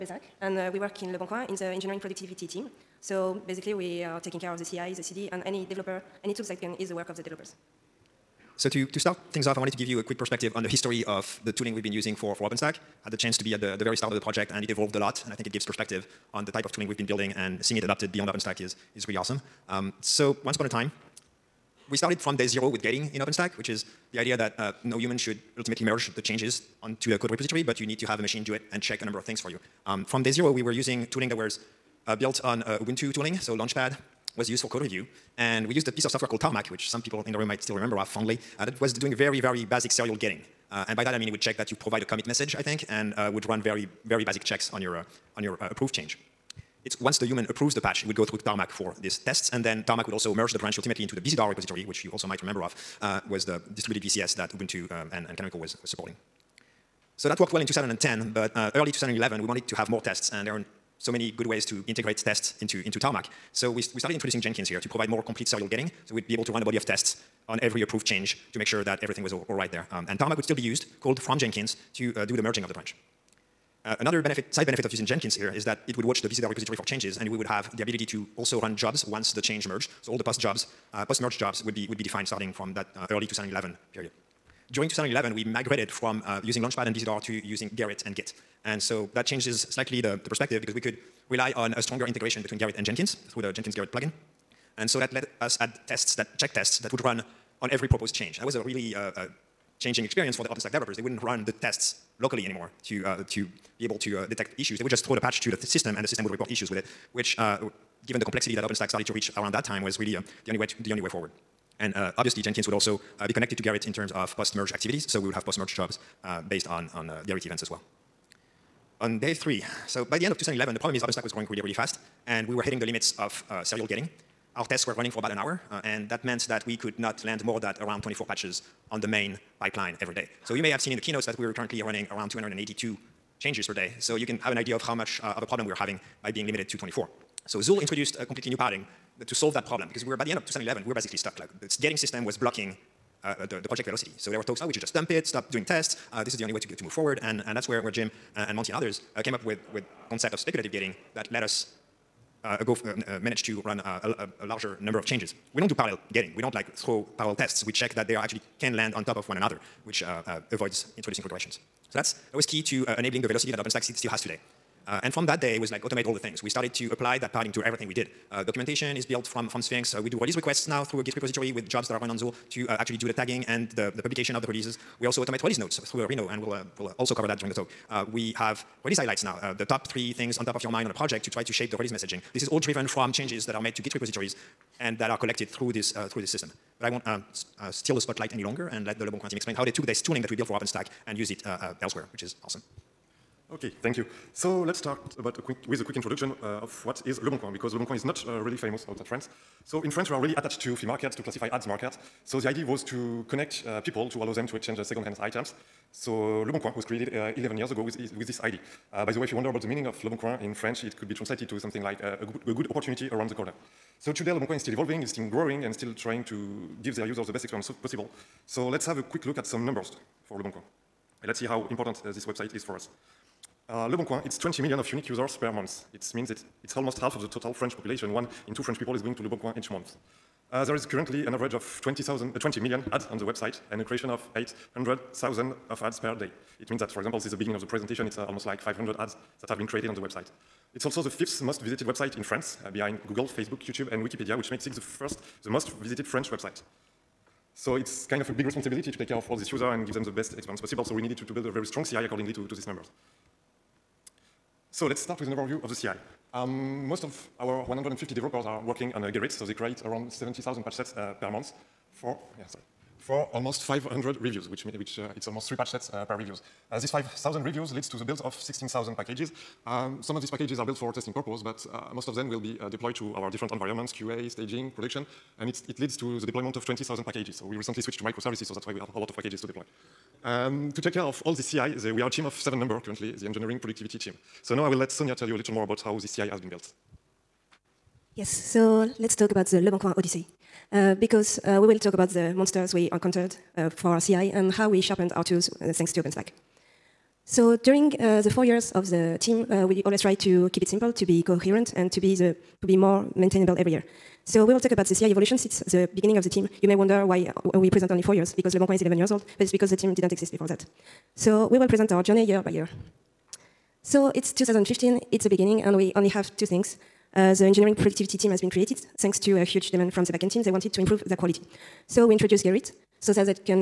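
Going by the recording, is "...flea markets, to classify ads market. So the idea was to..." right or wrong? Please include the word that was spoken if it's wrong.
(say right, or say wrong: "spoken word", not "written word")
right.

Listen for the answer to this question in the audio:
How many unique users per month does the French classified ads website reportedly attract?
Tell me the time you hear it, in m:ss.
3:44.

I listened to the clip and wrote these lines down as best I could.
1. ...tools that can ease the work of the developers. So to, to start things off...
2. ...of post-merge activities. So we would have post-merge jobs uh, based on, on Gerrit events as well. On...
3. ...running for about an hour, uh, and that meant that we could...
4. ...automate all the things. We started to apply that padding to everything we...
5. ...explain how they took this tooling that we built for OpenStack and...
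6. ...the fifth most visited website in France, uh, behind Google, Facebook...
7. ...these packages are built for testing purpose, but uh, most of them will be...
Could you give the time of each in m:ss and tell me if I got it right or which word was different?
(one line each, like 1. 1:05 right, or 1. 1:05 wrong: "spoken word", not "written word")
1. 0:06 right
2. 1:54 right
3. 2:04 right
4. 2:45 right
5. 3:09 right
6. 4:01 right
7. 4:30 right.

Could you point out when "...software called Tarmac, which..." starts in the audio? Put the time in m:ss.
0:36.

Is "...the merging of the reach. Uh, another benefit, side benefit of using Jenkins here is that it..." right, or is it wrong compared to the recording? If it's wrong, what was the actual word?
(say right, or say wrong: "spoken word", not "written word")
wrong: "branch", not "reach".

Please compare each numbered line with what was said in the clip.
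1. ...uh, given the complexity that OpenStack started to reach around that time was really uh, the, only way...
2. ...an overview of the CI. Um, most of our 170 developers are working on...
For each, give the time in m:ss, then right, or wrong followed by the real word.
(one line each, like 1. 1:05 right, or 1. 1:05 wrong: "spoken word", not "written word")
1. 1:47 right
2. 4:15 wrong: "150", not "170".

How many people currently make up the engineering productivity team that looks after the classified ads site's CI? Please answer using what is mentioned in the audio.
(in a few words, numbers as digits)
7.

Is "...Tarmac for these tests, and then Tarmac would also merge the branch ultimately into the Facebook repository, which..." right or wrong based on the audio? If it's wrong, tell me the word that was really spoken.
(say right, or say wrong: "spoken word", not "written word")
wrong: "Bazaar", not "Facebook".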